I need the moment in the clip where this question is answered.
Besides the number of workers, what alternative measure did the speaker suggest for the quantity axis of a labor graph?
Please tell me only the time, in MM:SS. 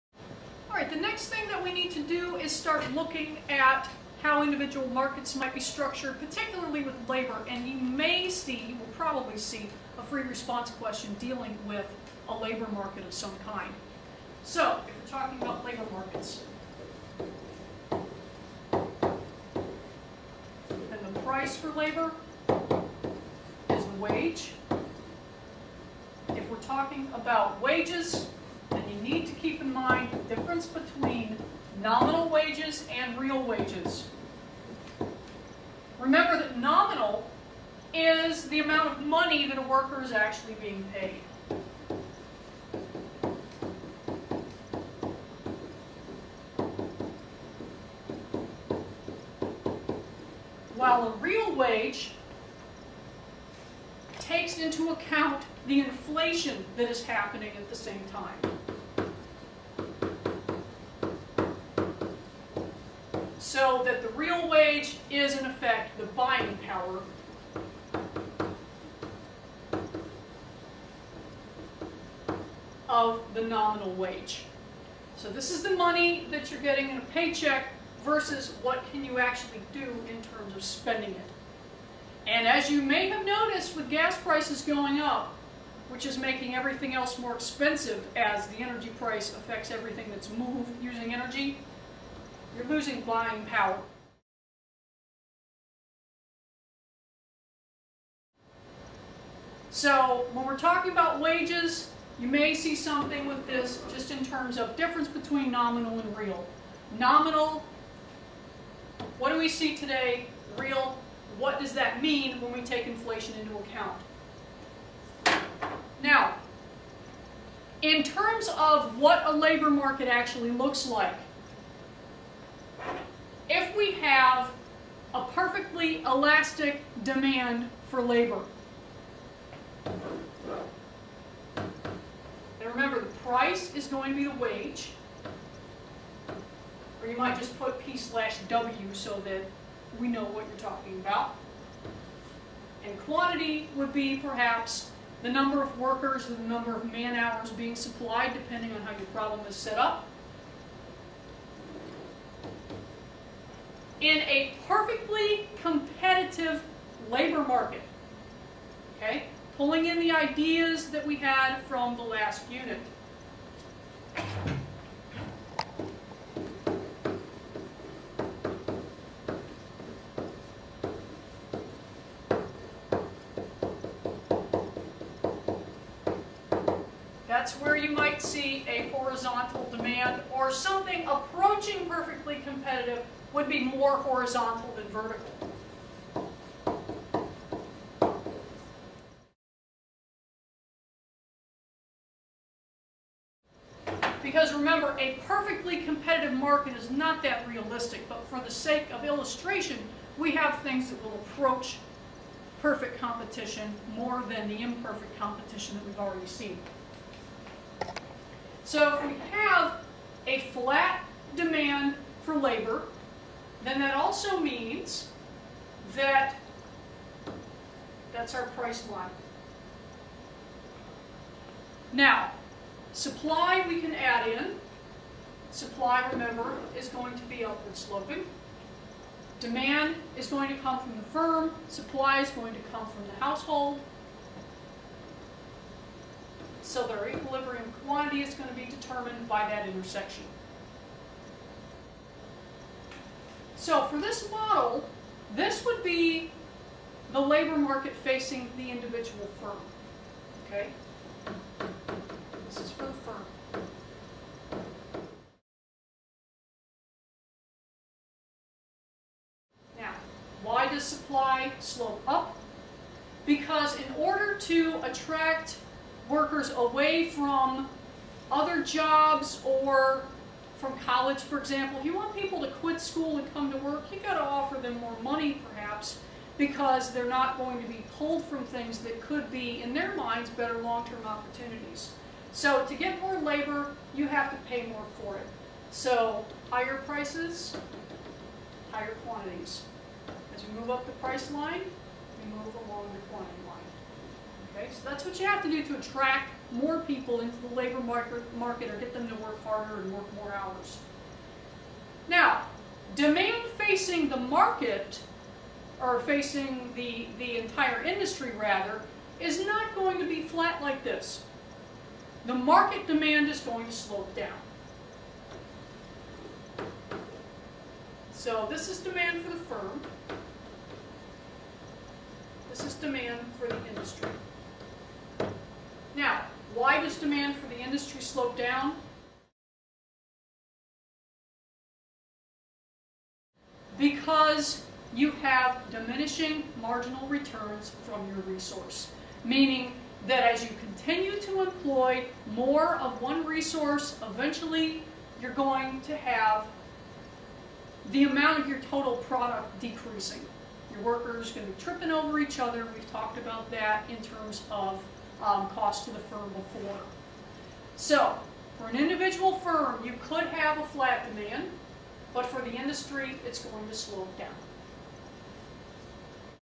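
02:26.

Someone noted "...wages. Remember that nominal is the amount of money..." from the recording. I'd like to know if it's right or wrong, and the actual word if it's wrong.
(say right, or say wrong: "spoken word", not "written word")
right.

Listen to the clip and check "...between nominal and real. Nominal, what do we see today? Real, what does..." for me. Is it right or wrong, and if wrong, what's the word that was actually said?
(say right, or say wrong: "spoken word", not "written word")
right.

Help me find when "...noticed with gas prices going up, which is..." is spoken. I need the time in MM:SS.
01:23.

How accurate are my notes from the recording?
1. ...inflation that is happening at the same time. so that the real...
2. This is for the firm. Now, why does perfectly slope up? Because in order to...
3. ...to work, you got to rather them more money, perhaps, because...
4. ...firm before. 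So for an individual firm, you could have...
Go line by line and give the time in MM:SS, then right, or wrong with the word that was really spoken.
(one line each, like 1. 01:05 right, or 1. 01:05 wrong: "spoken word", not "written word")
1. 00:55 right
2. 04:12 wrong: "supply", not "perfectly"
3. 04:33 wrong: "offer", not "rather"
4. 05:55 right.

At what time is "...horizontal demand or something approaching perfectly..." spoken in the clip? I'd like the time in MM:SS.
02:58.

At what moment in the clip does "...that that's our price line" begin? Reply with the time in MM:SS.
03:35.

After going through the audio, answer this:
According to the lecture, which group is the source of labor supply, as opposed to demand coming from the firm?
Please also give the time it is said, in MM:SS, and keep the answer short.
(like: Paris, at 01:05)
The household, at 03:53.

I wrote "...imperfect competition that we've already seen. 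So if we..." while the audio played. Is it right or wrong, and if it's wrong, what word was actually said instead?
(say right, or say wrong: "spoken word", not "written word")
right.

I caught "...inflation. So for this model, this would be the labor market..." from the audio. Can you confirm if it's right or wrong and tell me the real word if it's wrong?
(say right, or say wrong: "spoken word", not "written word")
wrong: "intersection", not "inflation".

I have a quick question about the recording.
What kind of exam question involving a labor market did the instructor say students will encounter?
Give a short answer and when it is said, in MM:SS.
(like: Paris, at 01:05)
Free response question, at 00:10.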